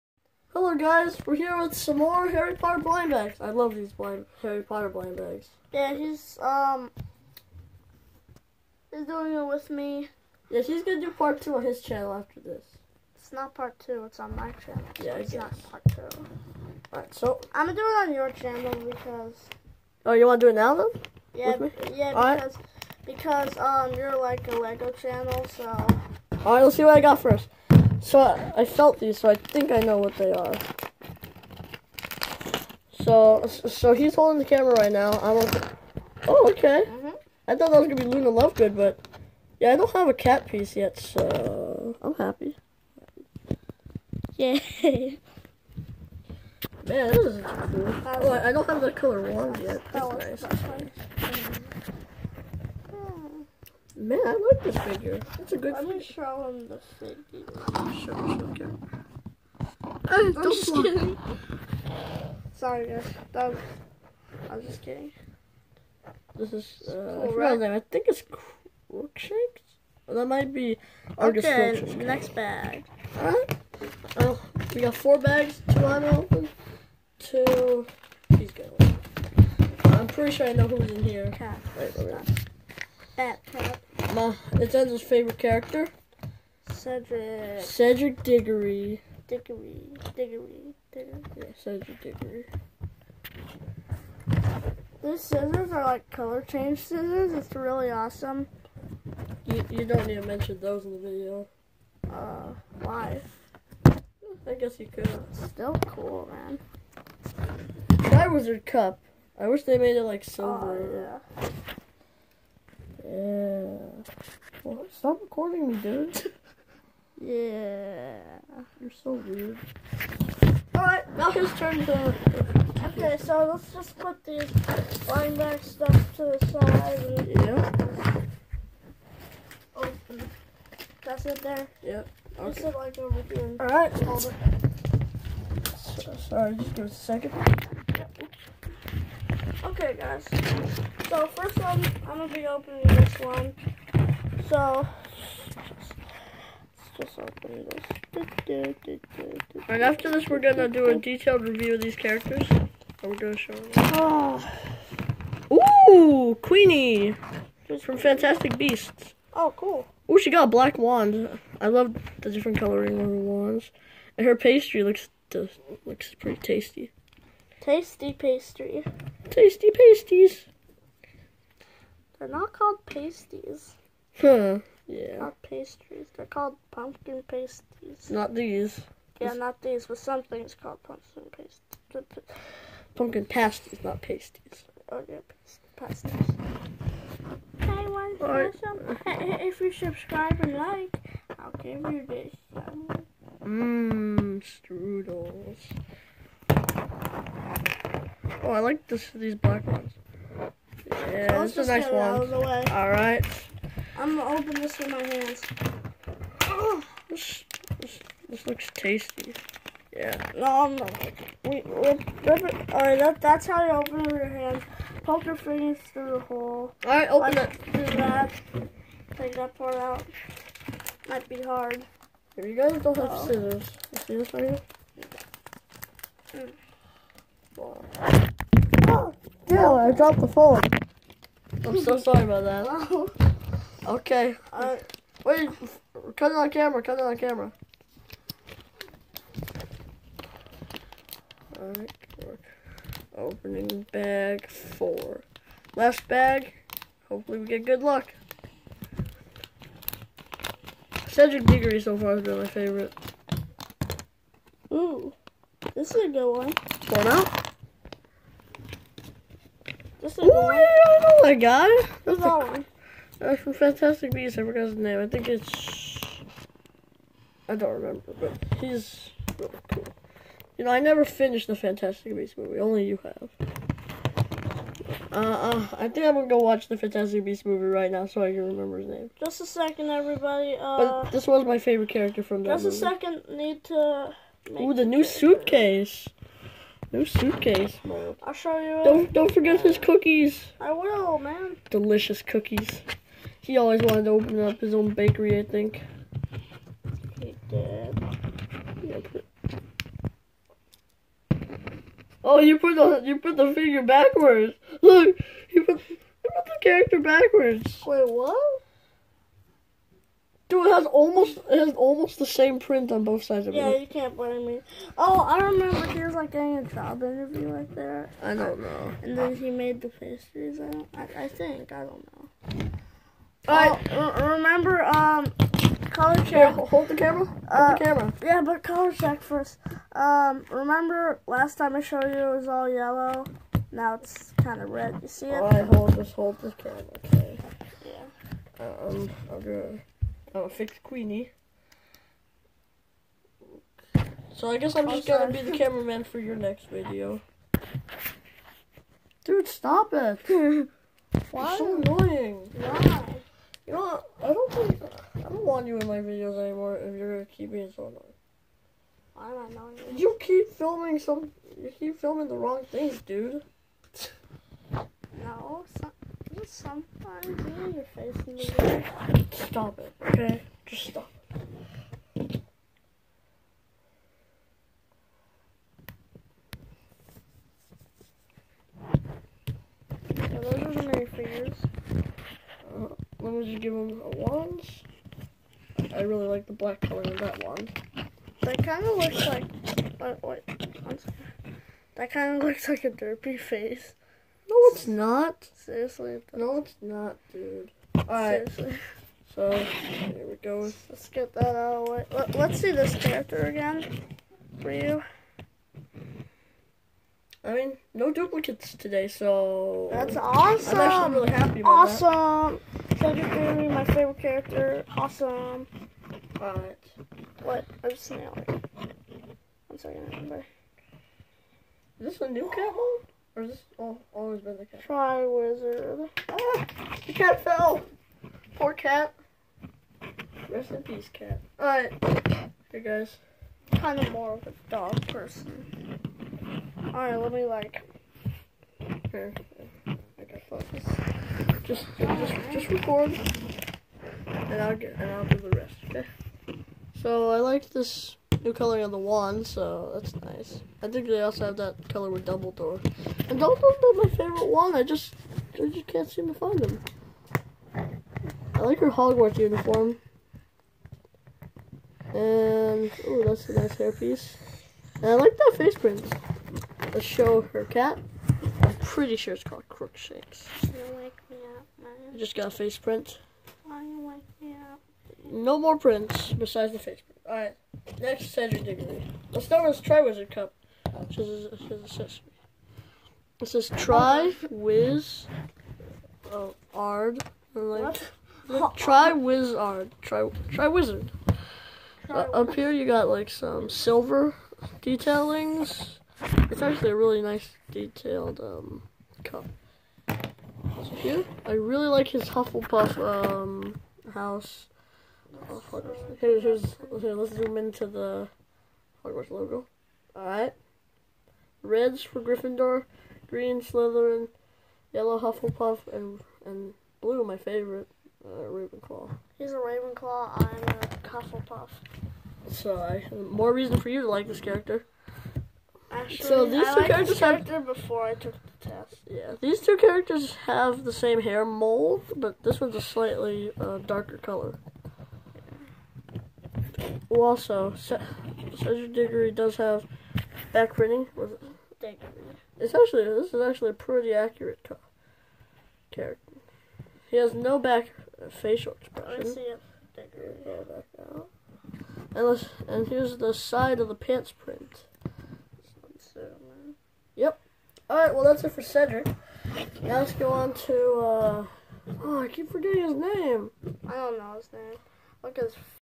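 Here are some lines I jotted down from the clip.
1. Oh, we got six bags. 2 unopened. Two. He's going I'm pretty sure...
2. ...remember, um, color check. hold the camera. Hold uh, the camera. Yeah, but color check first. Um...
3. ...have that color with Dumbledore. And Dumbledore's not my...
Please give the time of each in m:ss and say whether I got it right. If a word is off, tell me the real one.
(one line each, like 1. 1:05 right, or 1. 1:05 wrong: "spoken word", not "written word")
1. 1:14 wrong: "four", not "six"
2. 5:24 right
3. 7:31 right.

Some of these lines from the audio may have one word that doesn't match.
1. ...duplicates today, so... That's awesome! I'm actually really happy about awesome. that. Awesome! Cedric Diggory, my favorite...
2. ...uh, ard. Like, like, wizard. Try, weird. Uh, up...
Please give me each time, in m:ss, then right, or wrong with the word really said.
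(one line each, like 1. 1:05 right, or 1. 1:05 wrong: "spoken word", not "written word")
1. 6:48 right
2. 8:06 wrong: "wizard", not "weird".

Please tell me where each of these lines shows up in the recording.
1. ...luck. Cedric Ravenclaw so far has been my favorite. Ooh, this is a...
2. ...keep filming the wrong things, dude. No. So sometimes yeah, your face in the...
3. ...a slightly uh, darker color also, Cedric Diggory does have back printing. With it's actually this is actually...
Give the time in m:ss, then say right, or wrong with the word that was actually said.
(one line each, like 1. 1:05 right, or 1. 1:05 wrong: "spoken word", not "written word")
1. 4:07 wrong: "Diggory", not "Ravenclaw"
2. 6:01 right
3. 8:52 right.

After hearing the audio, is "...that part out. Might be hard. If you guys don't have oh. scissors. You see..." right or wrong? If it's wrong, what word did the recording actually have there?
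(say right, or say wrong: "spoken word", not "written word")
right.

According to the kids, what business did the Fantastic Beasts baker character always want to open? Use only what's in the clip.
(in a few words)
his own bakery.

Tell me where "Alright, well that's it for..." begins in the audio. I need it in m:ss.
9:17.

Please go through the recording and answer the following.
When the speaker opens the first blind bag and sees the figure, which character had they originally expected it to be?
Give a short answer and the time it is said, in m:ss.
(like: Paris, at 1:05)
Luna Lovegood, at 0:38.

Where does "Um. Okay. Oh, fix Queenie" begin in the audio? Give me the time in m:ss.
5:38.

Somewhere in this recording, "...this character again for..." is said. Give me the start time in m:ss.
6:42.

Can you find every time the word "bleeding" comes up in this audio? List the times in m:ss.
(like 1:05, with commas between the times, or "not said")
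not said.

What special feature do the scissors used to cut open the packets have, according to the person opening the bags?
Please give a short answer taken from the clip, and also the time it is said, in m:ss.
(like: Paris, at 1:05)
color change, at 1:36.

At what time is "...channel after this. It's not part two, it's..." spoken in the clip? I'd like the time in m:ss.
0:11.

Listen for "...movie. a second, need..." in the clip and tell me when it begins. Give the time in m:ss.
4:42.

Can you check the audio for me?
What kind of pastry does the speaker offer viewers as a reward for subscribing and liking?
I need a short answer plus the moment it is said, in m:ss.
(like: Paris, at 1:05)
strudels, at 3:14.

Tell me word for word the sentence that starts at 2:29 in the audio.
and after this, we're going to do a detailed review of these characters.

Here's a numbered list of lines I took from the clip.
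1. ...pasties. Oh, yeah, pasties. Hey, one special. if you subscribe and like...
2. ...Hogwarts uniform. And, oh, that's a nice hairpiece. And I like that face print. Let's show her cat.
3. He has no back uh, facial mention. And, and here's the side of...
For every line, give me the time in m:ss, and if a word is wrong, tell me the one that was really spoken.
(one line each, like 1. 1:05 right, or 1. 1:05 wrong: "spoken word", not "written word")
1. 3:04 right
2. 7:38 right
3. 9:07 wrong: "expression", not "mention".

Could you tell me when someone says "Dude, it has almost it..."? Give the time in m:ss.
5:10.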